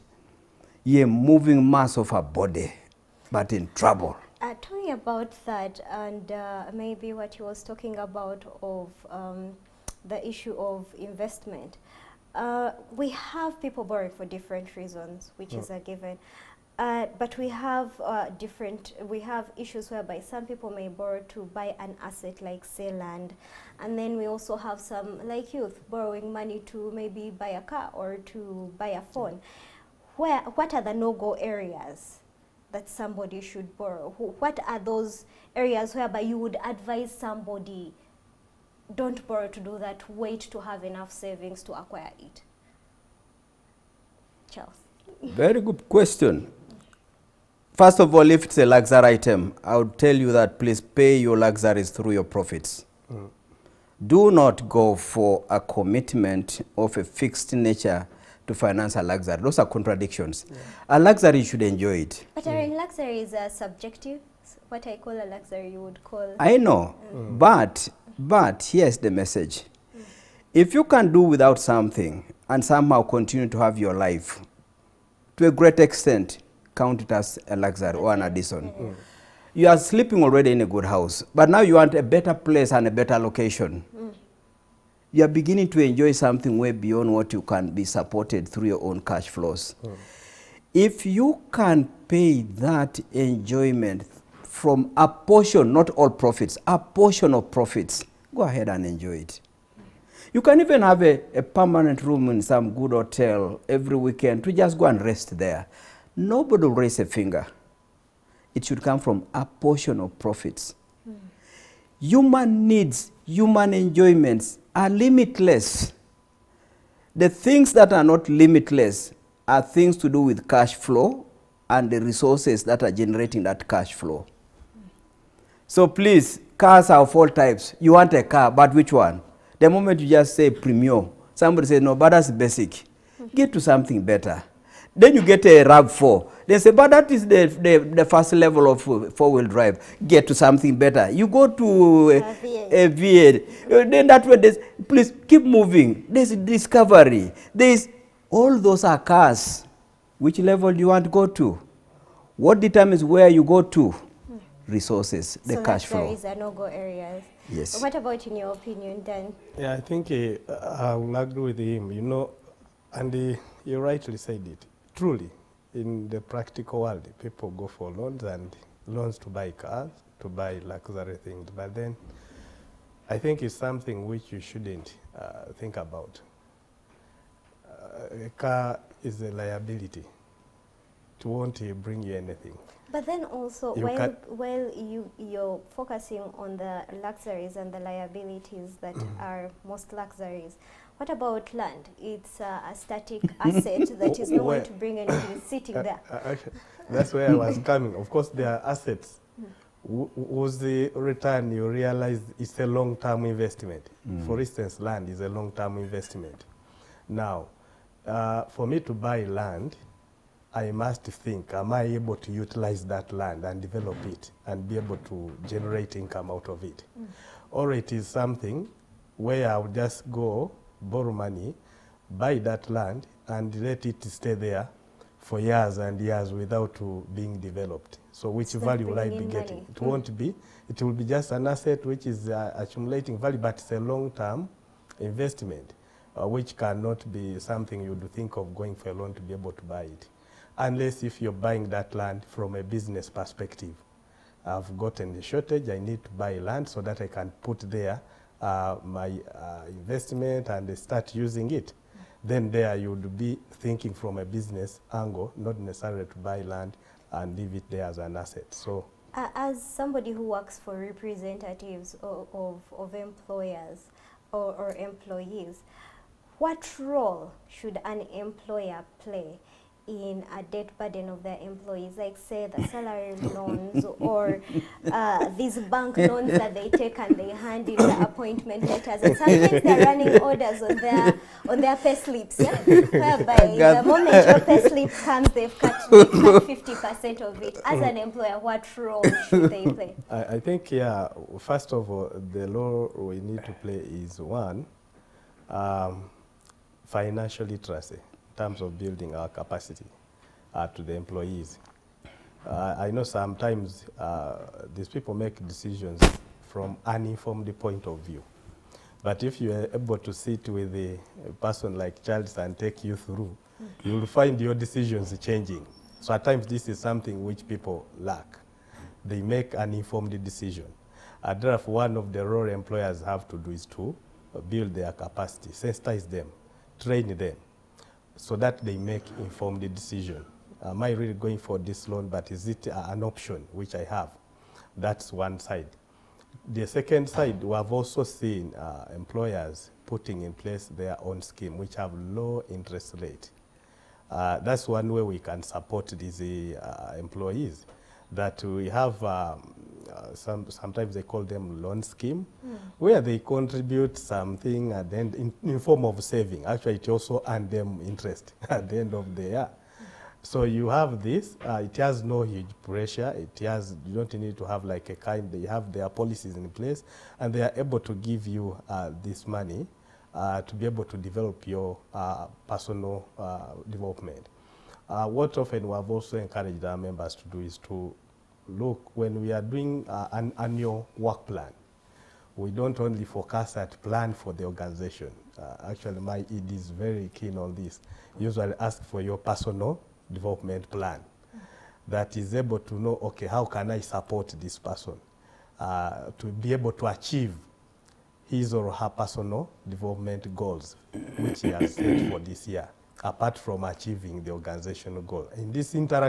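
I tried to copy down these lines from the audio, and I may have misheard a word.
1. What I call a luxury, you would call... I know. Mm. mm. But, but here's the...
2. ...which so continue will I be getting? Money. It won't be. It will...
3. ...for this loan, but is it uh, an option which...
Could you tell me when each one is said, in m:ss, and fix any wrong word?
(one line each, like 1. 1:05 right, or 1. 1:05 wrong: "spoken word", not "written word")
1. 1:04 right
2. 3:48 wrong: "value", not "continue"
3. 5:31 right.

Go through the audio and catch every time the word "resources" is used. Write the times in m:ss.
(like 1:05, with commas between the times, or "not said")
2:02, 2:34.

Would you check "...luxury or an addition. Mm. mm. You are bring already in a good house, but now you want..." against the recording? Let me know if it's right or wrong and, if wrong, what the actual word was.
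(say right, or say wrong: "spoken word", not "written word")
wrong: "sleeping", not "bring".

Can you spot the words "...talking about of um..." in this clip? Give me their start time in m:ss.
0:07.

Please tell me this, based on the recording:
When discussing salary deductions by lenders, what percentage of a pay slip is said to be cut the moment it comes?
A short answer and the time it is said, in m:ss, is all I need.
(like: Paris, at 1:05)
50 percent, at 4:46.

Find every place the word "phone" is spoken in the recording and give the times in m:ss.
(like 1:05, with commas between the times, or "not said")
0:29.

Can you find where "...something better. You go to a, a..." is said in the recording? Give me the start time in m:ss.
2:20.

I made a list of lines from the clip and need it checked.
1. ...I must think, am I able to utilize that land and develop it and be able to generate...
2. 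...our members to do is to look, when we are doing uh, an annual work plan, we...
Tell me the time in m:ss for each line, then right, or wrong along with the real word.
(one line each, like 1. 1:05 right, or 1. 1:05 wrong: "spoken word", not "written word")
1. 3:30 right
2. 6:16 right.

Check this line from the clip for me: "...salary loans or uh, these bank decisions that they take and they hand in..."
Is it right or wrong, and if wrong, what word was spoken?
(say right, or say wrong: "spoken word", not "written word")
wrong: "loans", not "decisions".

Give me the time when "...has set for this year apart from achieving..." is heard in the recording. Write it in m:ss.
6:41.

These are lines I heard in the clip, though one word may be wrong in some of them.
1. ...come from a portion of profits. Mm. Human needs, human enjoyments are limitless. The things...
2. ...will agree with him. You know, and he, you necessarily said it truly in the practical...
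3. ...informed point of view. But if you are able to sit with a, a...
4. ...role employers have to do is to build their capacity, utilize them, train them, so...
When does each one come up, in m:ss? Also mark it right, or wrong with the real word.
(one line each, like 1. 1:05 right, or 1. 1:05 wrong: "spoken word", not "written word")
1. 1:48 right
2. 2:40 wrong: "rightly", not "necessarily"
3. 5:06 wrong: "uninformed", not "informed"
4. 5:22 wrong: "sensitize", not "utilize".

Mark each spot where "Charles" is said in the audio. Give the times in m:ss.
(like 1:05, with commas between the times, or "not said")
0:44, 5:12.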